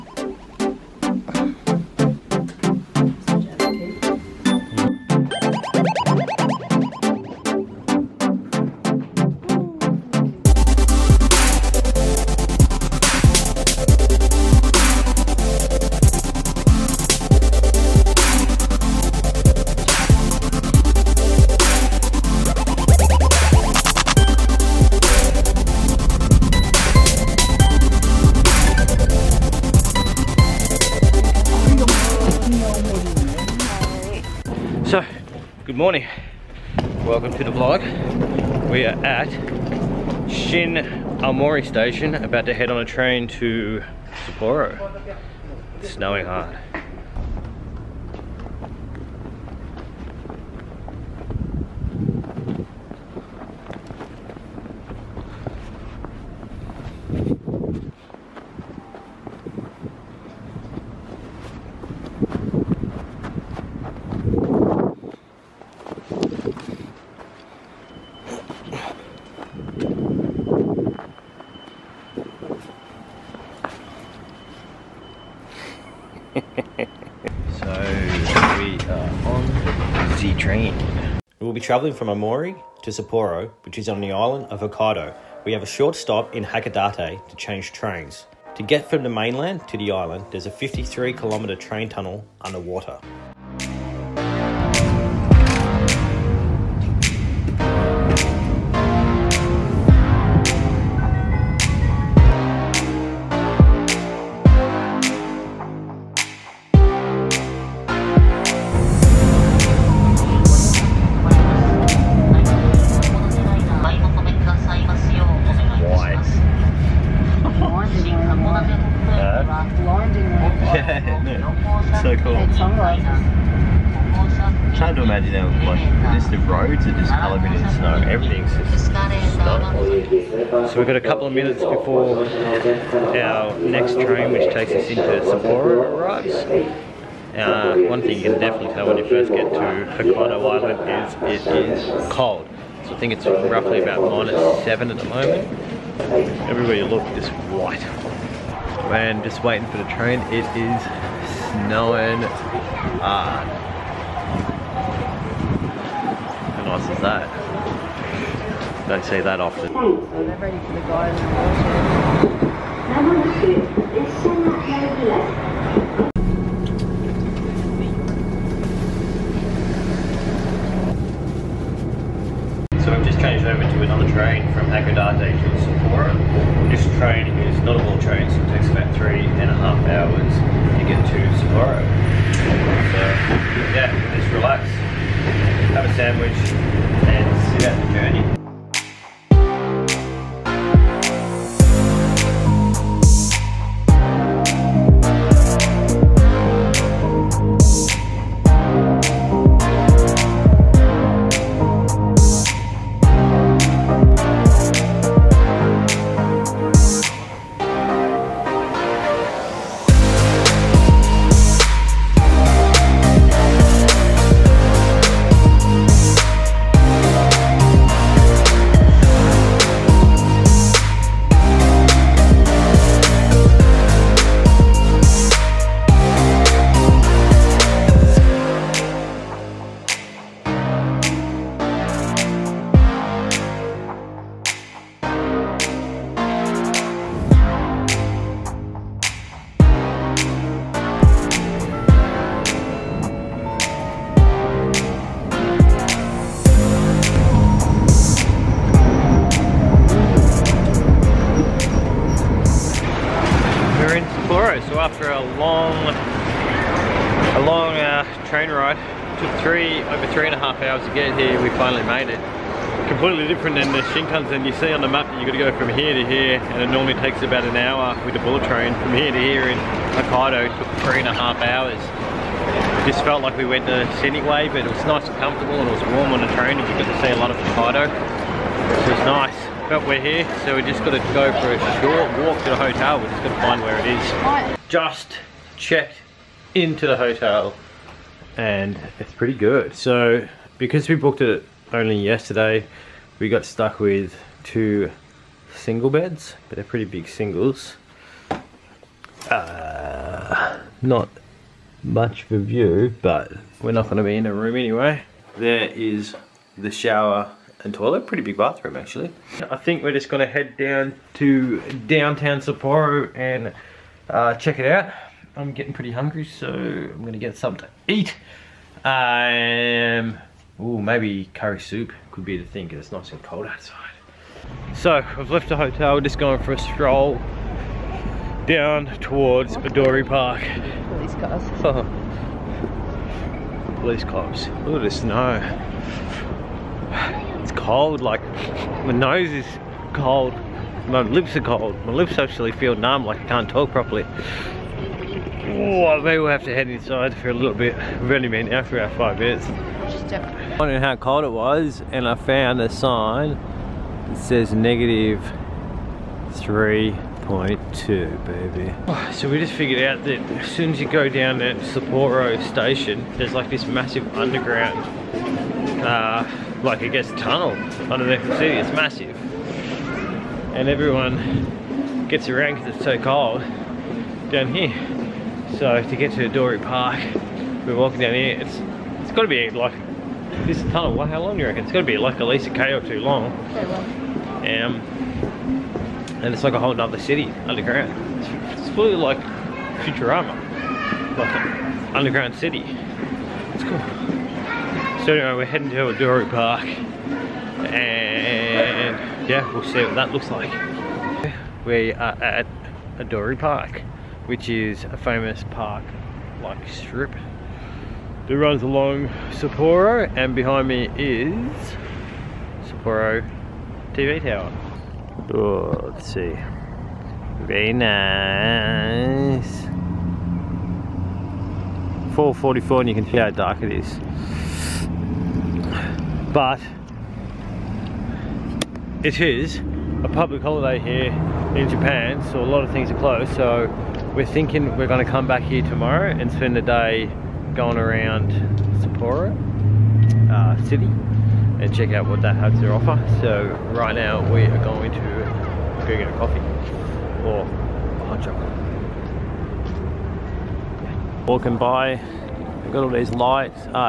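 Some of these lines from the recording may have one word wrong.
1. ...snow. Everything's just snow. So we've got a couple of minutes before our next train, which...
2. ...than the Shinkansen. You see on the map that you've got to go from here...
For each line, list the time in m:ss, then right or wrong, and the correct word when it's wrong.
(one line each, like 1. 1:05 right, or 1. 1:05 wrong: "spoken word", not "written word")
1. 2:07 right
2. 4:23 right.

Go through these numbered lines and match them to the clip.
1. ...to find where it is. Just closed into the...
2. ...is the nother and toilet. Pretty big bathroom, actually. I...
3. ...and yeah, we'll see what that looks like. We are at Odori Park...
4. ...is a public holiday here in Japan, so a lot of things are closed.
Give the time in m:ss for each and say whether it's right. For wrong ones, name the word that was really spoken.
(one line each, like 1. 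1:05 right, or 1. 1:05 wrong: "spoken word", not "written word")
1. 4:43 wrong: "checked", not "closed"
2. 5:05 wrong: "shower", not "nother"
3. 6:36 right
4. 7:09 right.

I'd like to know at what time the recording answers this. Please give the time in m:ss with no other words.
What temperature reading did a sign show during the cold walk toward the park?
5:54.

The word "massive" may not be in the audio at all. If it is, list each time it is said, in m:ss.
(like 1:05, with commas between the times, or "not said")
6:03, 6:08.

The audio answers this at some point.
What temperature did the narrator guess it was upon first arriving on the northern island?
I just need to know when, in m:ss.
2:24.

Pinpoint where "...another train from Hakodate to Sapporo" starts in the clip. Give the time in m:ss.
2:53.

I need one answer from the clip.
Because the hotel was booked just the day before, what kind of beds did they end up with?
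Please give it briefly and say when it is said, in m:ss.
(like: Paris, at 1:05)
two single beds, at 4:54.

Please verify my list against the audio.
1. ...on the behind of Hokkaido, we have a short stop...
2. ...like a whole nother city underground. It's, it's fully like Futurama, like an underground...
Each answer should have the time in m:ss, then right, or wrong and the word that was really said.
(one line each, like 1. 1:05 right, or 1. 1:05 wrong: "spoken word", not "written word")
1. 1:23 wrong: "island", not "behind"
2. 6:26 right.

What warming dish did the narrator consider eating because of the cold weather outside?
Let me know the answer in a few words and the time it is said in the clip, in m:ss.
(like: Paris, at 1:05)
curry soup, at 5:21.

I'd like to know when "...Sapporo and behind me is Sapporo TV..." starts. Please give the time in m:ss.
6:49.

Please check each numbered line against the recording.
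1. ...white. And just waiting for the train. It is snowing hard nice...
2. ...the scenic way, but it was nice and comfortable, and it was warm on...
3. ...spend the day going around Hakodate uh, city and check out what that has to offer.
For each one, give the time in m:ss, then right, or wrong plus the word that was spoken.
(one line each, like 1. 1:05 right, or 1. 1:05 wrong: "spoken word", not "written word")
1. 2:27 right
2. 4:33 right
3. 7:16 wrong: "Sapporo", not "Hakodate".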